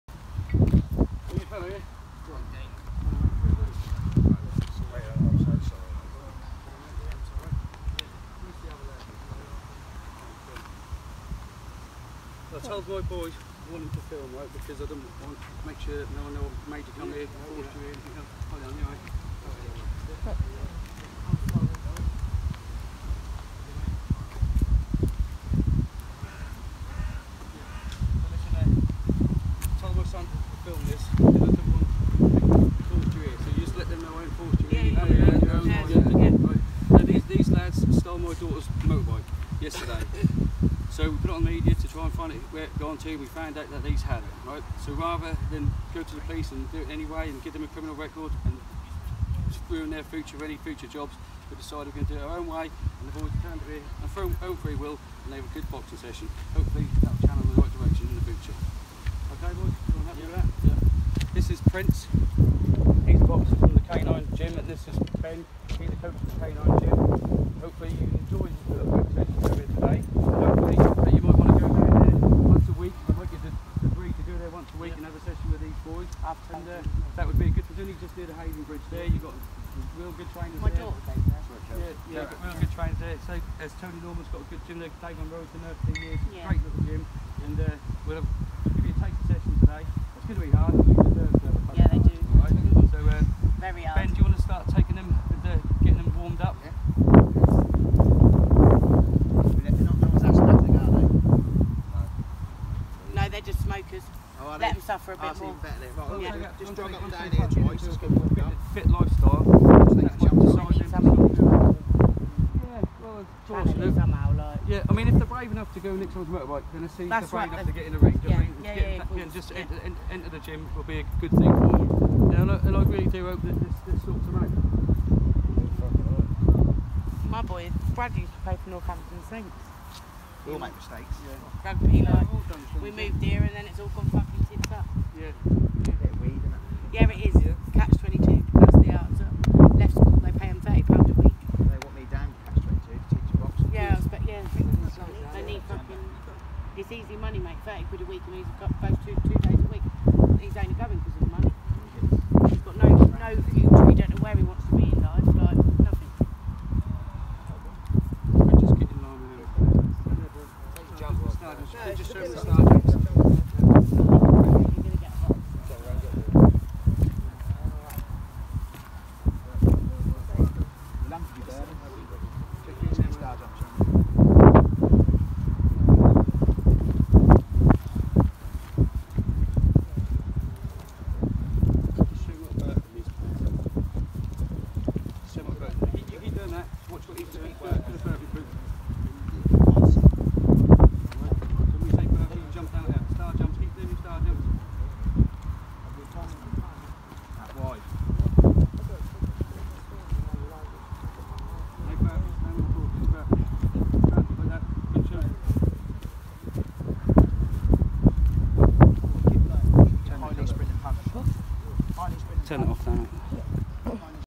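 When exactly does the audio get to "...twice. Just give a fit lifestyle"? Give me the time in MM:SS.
01:47.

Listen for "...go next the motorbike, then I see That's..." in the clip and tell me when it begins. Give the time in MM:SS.
01:55.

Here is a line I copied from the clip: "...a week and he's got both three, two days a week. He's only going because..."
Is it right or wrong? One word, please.
wrong.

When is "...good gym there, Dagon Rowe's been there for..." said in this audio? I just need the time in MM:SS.
01:24.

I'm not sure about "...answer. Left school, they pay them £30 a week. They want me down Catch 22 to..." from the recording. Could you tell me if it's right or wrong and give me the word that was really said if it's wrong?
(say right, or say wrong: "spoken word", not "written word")
right.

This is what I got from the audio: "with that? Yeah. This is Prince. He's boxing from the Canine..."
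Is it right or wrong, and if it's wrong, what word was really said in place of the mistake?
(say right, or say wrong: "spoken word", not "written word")
right.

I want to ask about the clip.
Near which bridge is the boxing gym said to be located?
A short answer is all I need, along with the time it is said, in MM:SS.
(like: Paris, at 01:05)
Haven Bridge, at 01:18.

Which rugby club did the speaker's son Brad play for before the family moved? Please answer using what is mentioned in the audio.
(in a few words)
Northampton Saints.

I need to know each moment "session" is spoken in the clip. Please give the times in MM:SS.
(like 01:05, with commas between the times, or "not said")
00:55, 01:15, 01:29.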